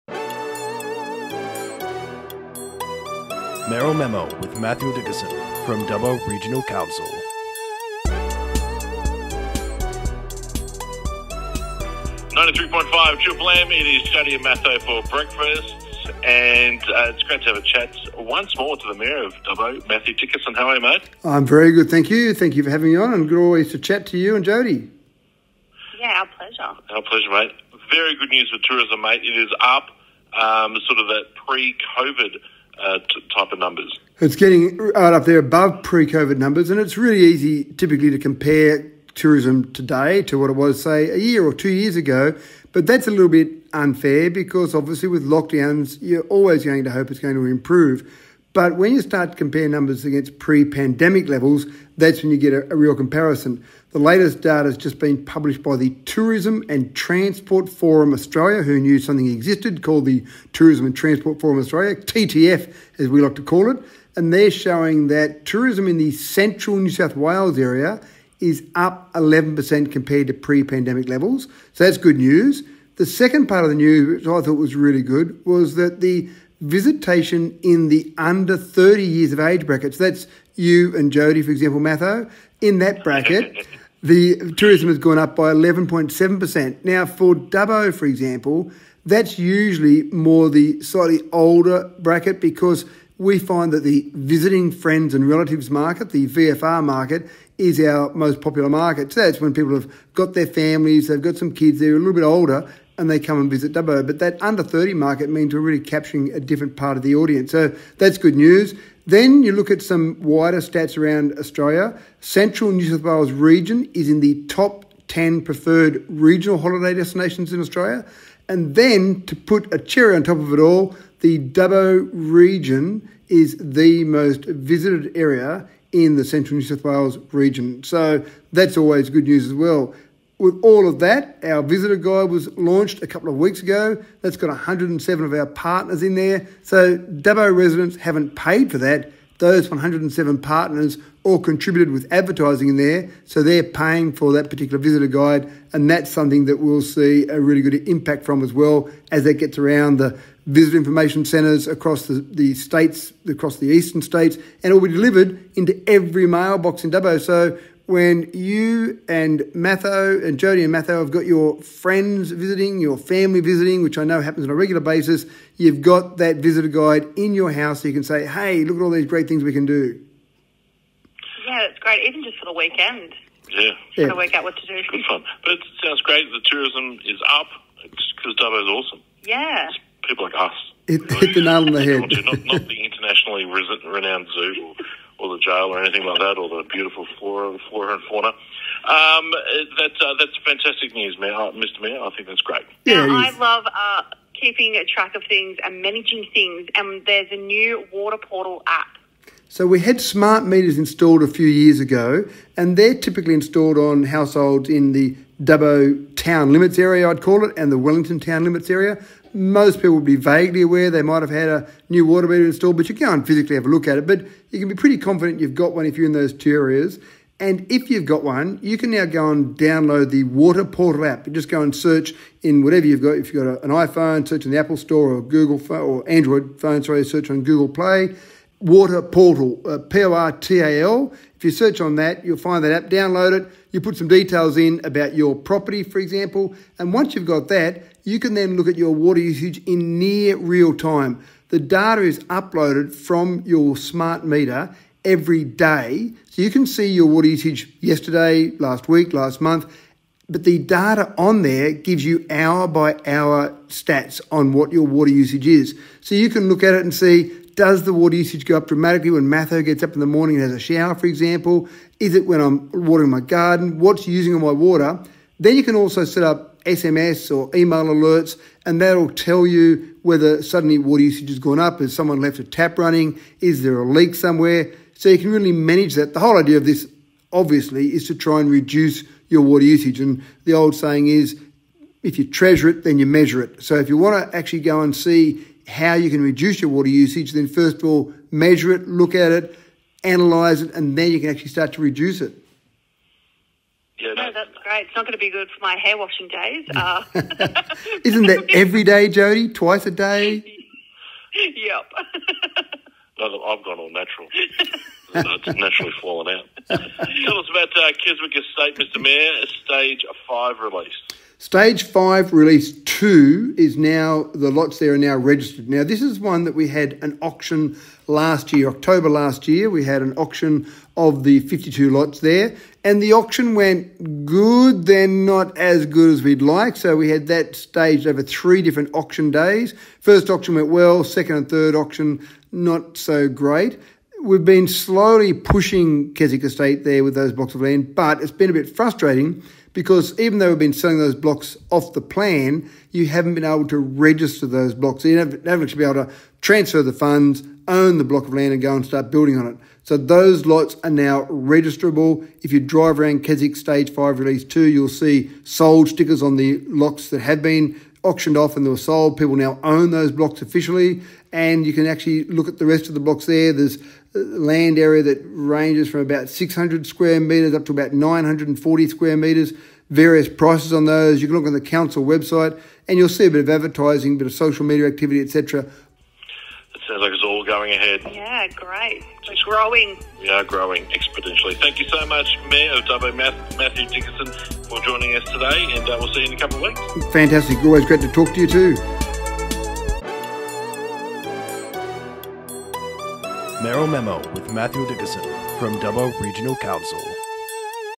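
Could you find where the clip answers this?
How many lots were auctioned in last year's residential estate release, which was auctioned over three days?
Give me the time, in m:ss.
5:21.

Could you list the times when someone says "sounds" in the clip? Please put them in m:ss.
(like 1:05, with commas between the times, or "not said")
2:55, 6:16.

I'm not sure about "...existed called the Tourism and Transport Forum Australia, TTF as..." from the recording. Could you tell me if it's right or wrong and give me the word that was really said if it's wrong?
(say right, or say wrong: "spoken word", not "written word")
right.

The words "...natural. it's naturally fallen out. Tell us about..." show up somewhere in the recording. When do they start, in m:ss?
5:03.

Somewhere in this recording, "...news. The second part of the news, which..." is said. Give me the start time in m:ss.
1:12.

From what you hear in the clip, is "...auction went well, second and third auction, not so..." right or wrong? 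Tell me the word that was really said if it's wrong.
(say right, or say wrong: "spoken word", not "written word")
right.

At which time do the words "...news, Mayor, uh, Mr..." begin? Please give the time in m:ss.
3:10.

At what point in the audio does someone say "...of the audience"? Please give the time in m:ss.
1:46.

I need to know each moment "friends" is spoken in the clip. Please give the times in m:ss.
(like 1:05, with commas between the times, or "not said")
1:34, 2:41.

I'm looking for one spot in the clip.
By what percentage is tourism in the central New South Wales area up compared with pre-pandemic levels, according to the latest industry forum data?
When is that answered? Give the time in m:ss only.
1:09.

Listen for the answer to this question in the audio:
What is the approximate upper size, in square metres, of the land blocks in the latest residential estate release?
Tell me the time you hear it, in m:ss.
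6:07.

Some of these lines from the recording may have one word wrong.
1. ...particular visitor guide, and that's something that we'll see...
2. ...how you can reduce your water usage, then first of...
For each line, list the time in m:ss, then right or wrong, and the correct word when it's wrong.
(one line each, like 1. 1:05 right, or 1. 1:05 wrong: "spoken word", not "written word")
1. 2:24 right
2. 4:45 right.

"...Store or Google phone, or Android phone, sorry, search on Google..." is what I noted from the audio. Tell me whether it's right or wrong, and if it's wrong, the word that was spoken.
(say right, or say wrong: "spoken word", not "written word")
right.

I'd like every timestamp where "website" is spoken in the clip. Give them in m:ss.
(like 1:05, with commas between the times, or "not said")
6:12.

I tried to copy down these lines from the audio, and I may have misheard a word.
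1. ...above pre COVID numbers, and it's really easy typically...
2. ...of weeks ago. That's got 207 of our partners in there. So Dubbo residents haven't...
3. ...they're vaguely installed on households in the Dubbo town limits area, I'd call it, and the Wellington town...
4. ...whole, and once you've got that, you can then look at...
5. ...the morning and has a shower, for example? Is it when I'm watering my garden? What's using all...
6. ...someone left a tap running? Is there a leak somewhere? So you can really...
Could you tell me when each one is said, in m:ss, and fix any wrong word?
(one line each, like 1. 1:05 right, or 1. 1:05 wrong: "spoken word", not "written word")
1. 0:35 right
2. 2:13 wrong: "107", not "207"
3. 3:22 wrong: "typically", not "vaguely"
4. 3:55 wrong: "example", not "whole"
5. 4:19 right
6. 4:31 right.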